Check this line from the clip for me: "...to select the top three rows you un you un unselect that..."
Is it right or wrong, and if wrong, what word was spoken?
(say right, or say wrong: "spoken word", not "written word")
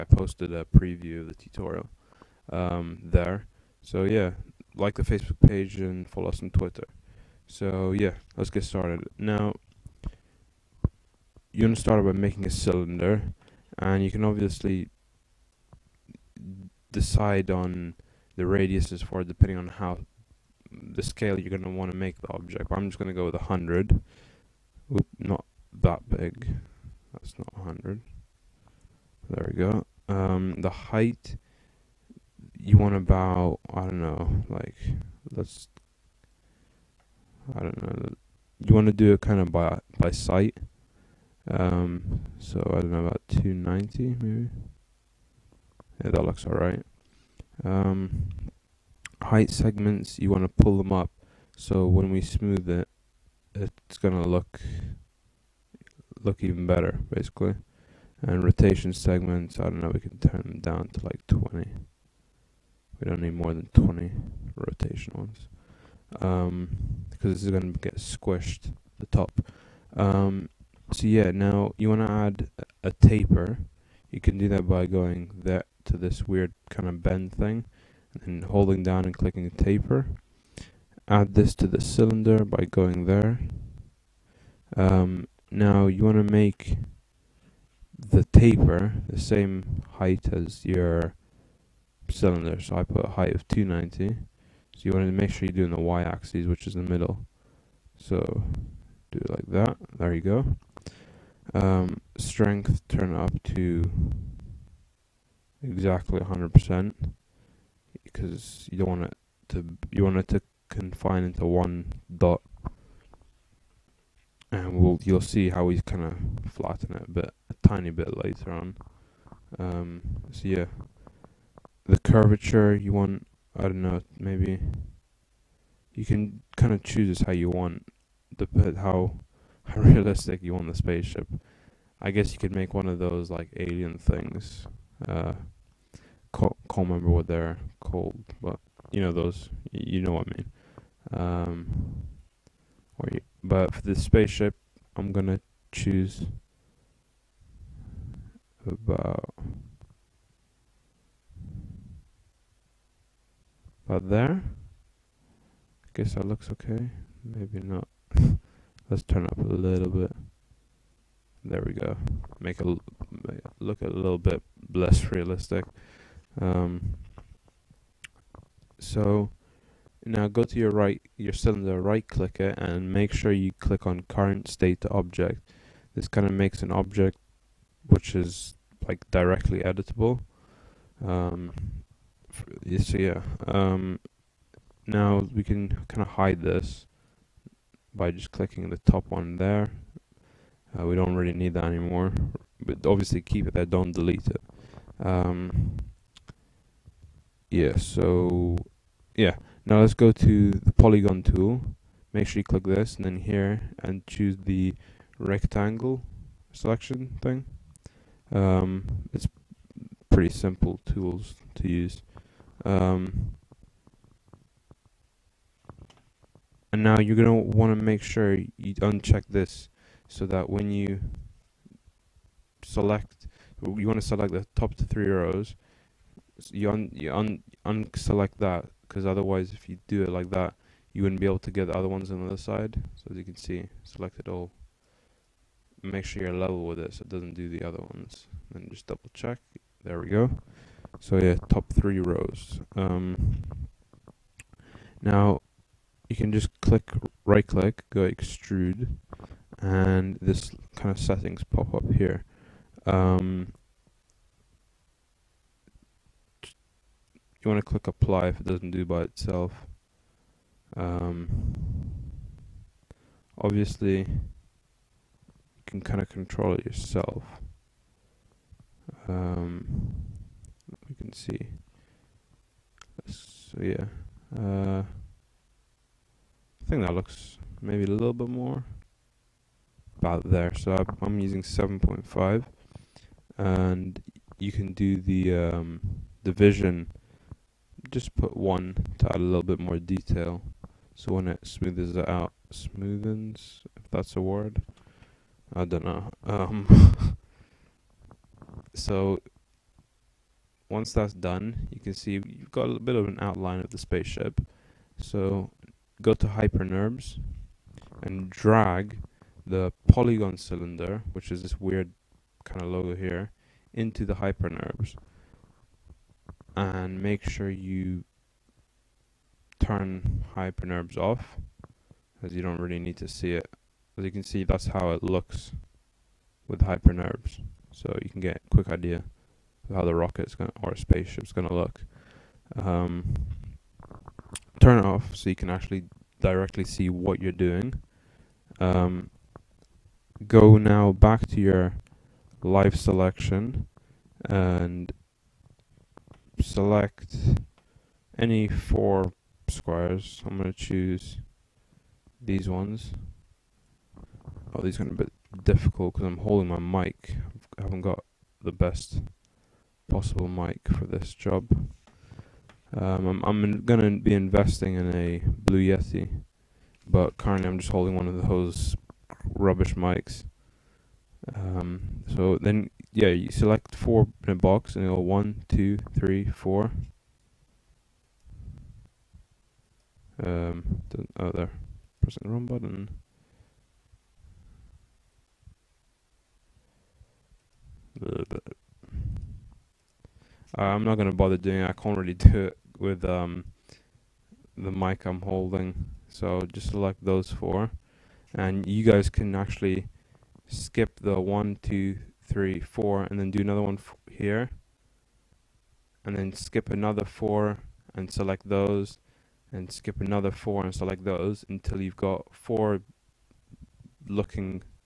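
right.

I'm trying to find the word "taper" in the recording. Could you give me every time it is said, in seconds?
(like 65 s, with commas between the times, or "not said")
72 s, 79 s, 88 s.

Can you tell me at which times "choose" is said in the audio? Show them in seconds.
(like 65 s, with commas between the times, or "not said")
126 s, 145 s, 204 s, 350 s.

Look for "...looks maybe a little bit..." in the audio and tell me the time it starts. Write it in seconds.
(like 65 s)
276 s.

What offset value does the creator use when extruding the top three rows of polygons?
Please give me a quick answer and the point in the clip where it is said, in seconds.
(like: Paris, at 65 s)
7.5, at 281 s.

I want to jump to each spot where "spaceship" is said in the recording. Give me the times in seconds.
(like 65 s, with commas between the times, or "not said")
130 s, 143 s, 303 s, 330 s.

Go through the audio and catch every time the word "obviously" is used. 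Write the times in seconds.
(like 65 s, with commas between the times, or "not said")
14 s, 192 s, 263 s.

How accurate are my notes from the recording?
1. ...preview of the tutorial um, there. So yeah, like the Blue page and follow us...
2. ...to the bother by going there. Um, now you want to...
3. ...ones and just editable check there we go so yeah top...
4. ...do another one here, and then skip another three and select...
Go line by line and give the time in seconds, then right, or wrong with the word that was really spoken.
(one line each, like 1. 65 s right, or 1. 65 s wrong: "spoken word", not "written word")
1. 0 s wrong: "Facebook", not "Blue"
2. 81 s wrong: "cylinder", not "bother"
3. 237 s wrong: "double", not "editable"
4. 403 s wrong: "four", not "three".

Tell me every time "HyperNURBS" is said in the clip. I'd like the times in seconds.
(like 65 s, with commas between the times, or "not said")
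306 s, 314 s, 320 s, 326 s.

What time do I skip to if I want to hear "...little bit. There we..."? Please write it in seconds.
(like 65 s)
159 s.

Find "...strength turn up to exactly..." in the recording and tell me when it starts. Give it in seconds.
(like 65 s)
102 s.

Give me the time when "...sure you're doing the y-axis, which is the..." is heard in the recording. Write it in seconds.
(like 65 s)
95 s.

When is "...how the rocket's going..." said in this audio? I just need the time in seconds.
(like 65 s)
329 s.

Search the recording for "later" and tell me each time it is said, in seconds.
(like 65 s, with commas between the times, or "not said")
118 s.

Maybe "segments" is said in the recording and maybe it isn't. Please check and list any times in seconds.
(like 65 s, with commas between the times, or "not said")
49 s, 58 s.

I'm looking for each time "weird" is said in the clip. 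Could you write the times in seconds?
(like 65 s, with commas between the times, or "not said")
76 s, 311 s.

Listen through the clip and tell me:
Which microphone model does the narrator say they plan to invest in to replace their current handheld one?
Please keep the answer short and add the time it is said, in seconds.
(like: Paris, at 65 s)
Blue Yeti, at 365 s.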